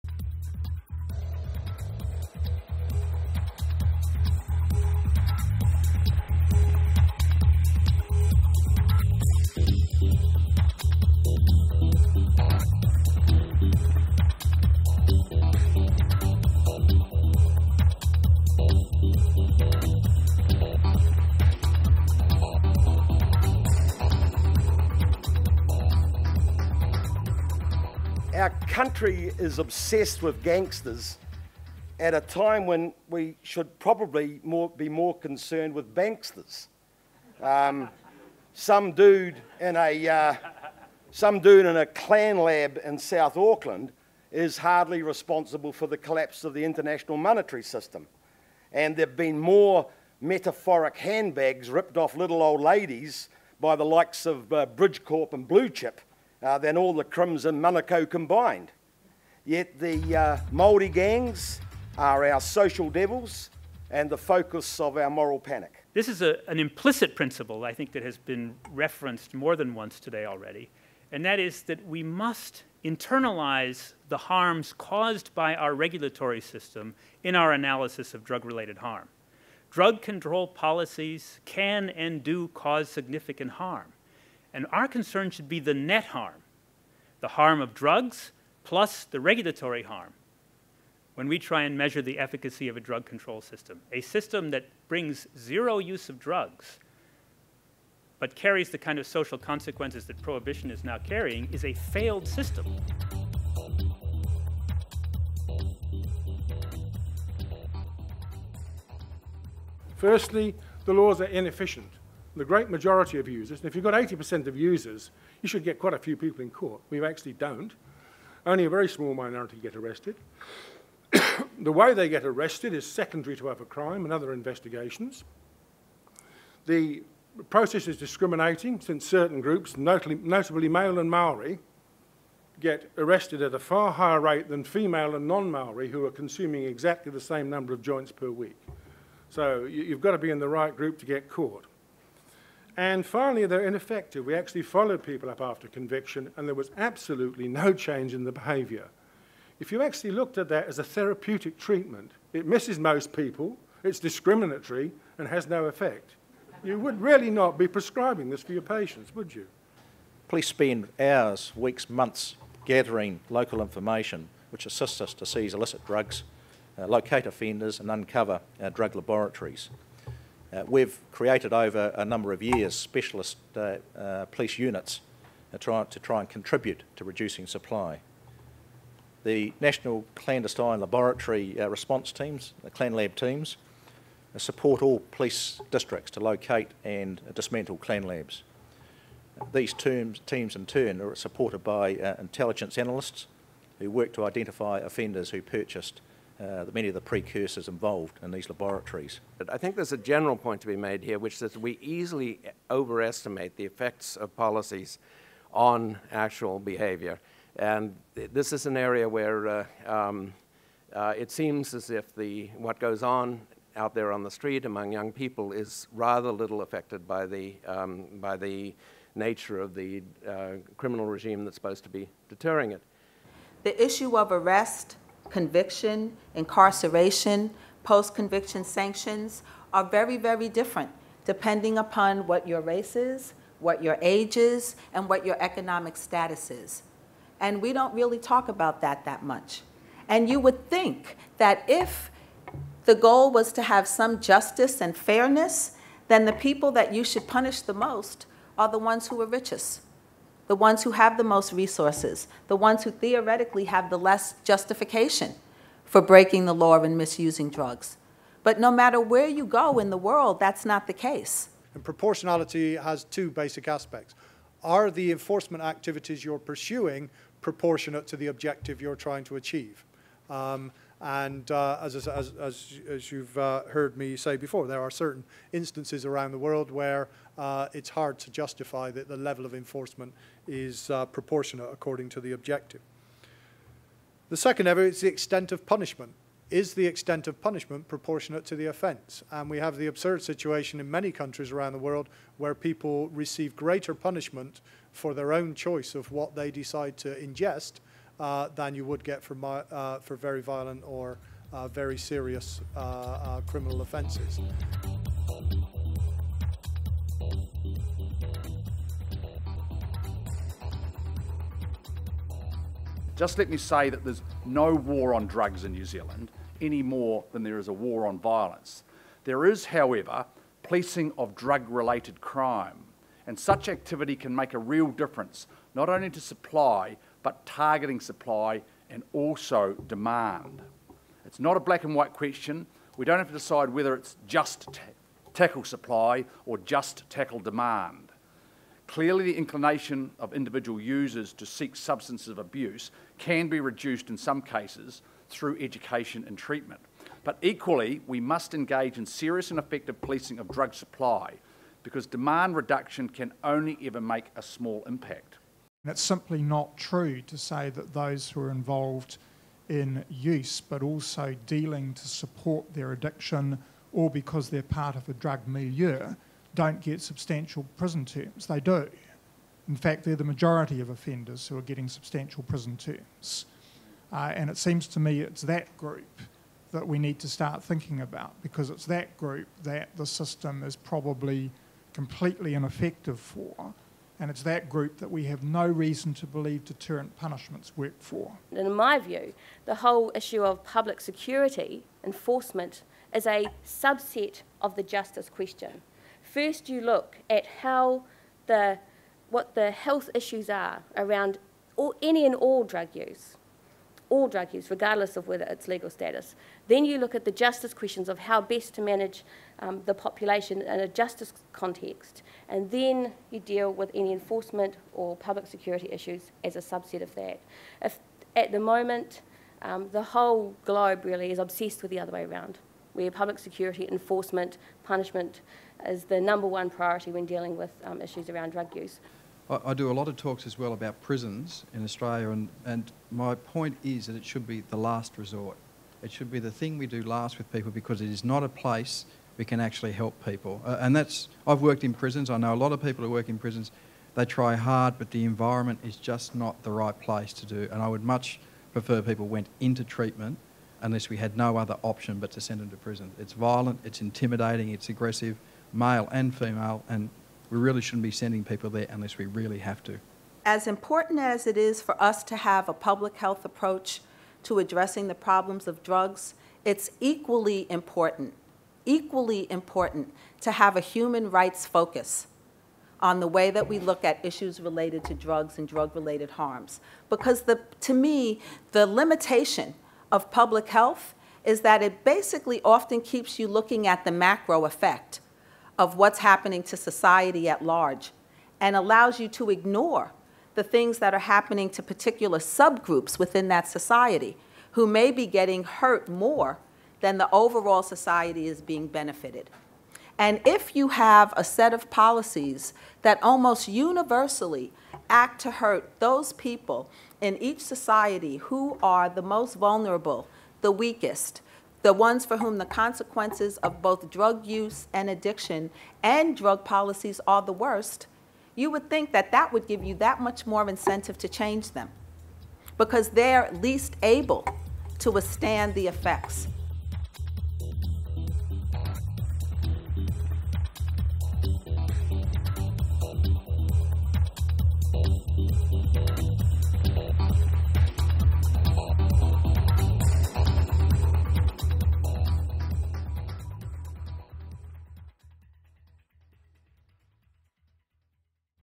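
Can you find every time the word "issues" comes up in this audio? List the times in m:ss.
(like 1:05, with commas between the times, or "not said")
3:43, 6:30, 6:40, 6:55, 7:08, 7:54.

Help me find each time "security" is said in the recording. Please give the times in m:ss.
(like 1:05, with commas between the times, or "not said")
6:31, 6:55, 7:03.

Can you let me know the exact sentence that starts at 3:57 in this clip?
And we don't really talk about that that much.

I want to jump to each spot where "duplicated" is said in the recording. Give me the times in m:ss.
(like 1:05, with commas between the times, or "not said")
not said.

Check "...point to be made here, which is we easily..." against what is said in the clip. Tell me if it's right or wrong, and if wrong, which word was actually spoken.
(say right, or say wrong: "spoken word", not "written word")
right.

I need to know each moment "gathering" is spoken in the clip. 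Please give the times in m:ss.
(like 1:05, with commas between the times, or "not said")
2:42.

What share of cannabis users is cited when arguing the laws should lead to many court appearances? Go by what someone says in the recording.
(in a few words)
80%.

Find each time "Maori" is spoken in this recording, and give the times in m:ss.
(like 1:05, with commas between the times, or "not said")
2:11, 2:15.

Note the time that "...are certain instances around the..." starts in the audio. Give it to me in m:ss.
4:34.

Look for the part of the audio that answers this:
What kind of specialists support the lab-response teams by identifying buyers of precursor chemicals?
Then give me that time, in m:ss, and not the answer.
3:12.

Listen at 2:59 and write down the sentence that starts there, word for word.
The National Clandestine Laboratory uh, Response Teams, the ClanLab teams, uh, support all police districts to locate and dismantle ClanLabs.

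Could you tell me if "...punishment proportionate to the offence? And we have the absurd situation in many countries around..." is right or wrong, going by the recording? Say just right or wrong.
right.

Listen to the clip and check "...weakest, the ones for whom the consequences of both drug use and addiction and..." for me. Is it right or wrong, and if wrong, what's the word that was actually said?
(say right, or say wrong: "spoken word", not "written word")
right.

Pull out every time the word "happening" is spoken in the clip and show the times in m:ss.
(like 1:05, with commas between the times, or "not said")
8:06, 8:11.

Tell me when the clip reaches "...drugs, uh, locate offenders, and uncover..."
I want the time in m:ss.
2:45.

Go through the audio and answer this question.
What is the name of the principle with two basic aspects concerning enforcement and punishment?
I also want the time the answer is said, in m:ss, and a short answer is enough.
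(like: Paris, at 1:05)
proportionality, at 4:21.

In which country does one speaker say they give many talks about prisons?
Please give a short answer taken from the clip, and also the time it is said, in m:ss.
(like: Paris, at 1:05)
Australia, at 7:11.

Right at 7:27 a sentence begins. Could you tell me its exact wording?
And I would much prefer people went into treatment unless we had no other option but to send them to prison.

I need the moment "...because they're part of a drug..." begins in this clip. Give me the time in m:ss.
6:04.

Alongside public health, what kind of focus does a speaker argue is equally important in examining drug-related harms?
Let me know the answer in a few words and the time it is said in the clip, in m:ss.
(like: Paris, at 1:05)
human rights, at 7:50.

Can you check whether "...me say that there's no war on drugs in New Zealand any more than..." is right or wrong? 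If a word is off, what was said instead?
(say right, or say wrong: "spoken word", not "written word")
right.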